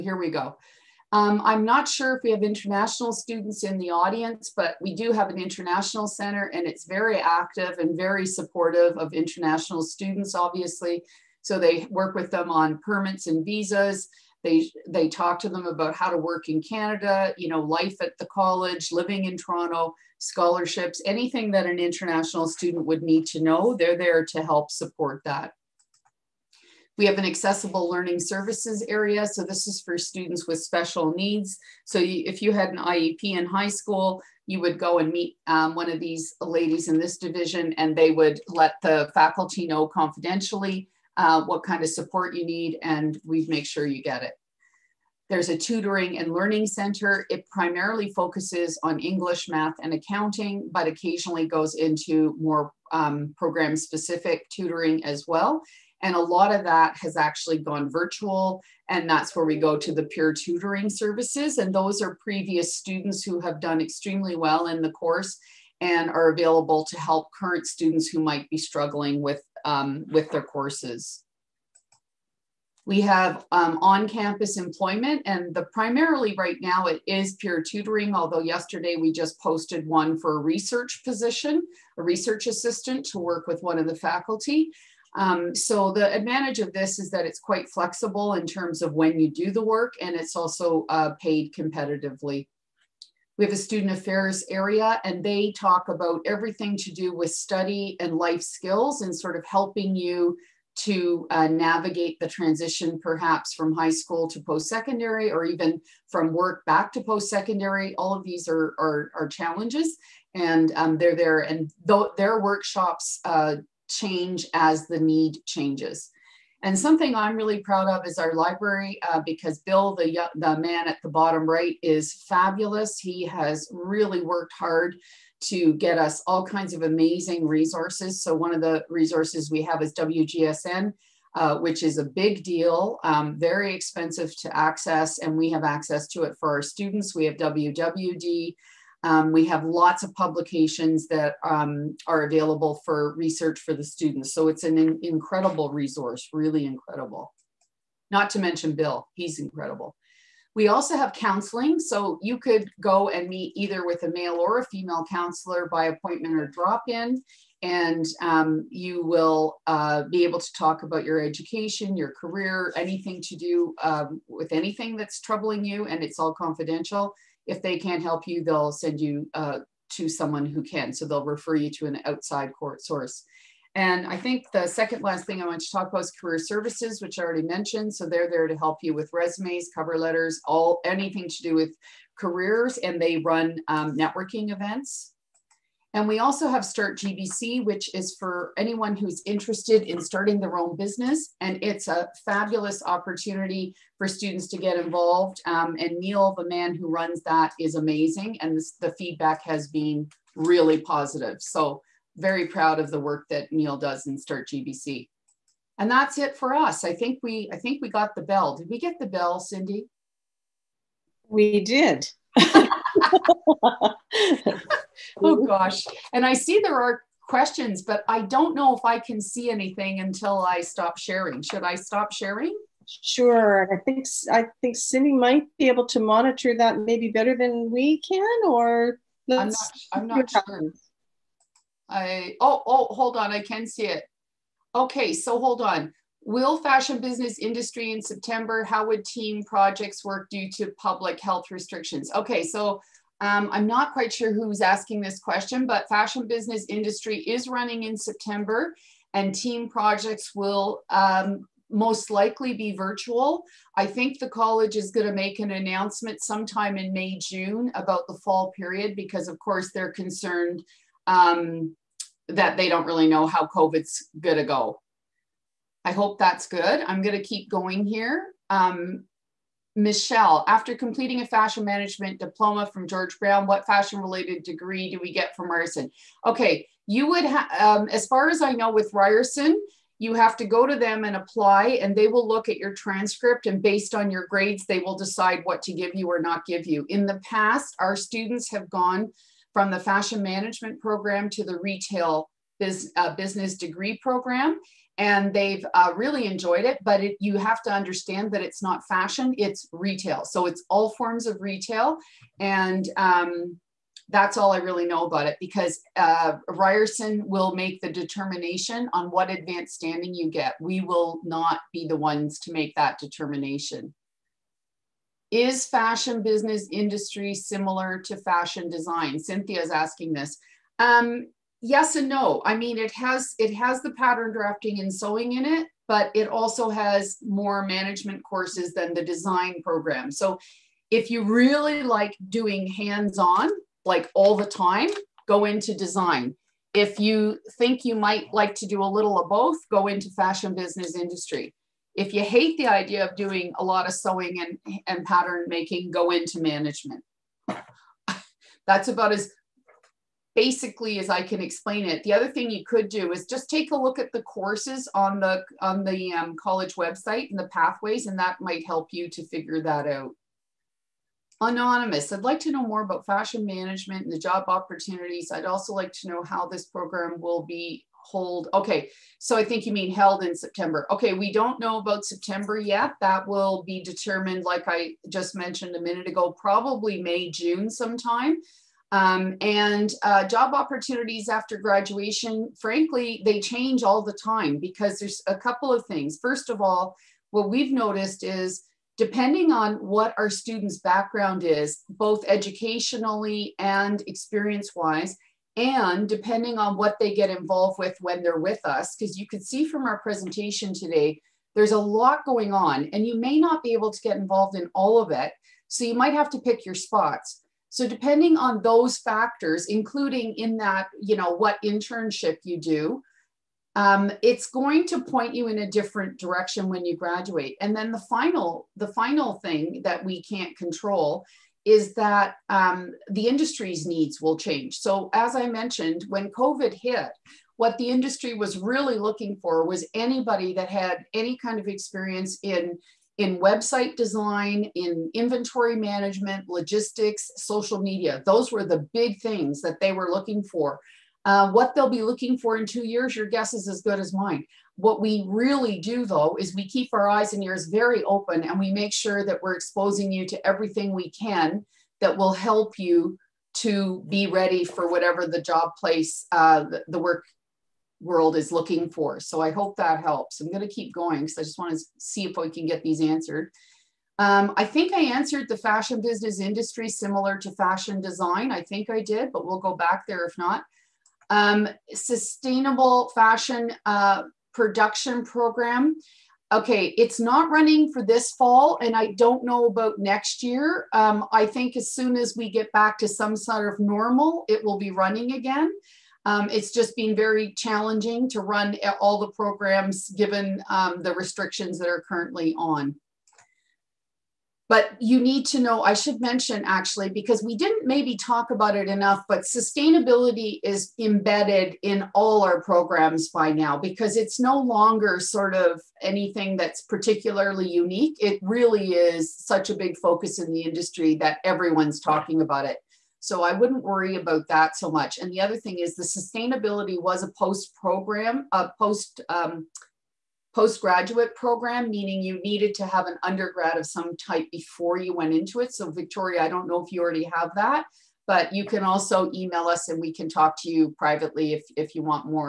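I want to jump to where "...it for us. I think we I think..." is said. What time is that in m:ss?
3:26.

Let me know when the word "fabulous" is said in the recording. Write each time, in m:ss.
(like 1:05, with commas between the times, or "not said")
2:02, 3:12.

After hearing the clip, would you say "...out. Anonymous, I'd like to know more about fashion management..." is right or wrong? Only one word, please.
right.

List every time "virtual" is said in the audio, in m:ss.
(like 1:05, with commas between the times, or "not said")
0:57, 4:12.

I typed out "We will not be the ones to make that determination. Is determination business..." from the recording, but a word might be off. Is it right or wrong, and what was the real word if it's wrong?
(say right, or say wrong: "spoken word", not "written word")
wrong: "fashion", not "determination".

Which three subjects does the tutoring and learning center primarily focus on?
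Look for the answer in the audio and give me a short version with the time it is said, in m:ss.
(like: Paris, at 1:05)
English, math, and accounting, at 0:48.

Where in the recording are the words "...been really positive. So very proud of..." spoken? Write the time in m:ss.
3:19.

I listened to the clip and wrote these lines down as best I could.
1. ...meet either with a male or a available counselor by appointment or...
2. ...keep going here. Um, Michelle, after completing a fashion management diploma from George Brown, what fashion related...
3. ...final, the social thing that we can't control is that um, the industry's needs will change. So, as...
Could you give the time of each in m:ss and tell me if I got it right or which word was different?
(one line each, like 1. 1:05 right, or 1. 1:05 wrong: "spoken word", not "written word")
1. 2:33 wrong: "female", not "available"
2. 4:27 right
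3. 6:57 wrong: "final", not "social".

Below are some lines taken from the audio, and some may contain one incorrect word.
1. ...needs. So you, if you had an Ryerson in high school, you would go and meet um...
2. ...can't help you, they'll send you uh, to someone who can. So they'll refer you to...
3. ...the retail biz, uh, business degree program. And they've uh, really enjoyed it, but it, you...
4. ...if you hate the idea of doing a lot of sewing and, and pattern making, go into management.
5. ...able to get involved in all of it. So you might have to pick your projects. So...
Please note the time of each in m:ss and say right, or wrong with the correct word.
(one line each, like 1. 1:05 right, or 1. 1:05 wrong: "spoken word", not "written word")
1. 0:31 wrong: "IEP", not "Ryerson"
2. 2:47 right
3. 4:51 right
4. 5:41 right
5. 6:43 wrong: "spots", not "projects".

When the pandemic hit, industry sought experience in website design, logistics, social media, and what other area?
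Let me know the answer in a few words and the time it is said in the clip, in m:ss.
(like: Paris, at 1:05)
Inventory management, at 7:15.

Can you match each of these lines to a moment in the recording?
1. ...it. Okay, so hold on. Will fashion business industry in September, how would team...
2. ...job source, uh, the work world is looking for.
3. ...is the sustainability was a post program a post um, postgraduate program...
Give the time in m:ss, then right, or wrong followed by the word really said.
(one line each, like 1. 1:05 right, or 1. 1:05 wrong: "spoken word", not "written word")
1. 3:53 right
2. 7:35 wrong: "place", not "source"
3. 8:35 right.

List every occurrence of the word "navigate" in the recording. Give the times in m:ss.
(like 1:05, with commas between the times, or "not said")
1:41.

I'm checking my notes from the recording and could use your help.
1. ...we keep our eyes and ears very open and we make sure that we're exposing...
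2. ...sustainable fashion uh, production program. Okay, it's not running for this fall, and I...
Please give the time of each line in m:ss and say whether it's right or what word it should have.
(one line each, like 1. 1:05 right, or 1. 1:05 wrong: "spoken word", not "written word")
1. 7:26 right
2. 7:51 right.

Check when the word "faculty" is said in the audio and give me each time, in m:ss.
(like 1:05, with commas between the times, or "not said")
0:39, 1:23.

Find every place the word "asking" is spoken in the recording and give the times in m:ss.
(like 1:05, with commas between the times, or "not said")
4:04, 5:19.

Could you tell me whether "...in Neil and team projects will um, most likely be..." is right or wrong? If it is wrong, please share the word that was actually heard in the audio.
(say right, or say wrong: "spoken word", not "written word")
wrong: "September", not "Neil".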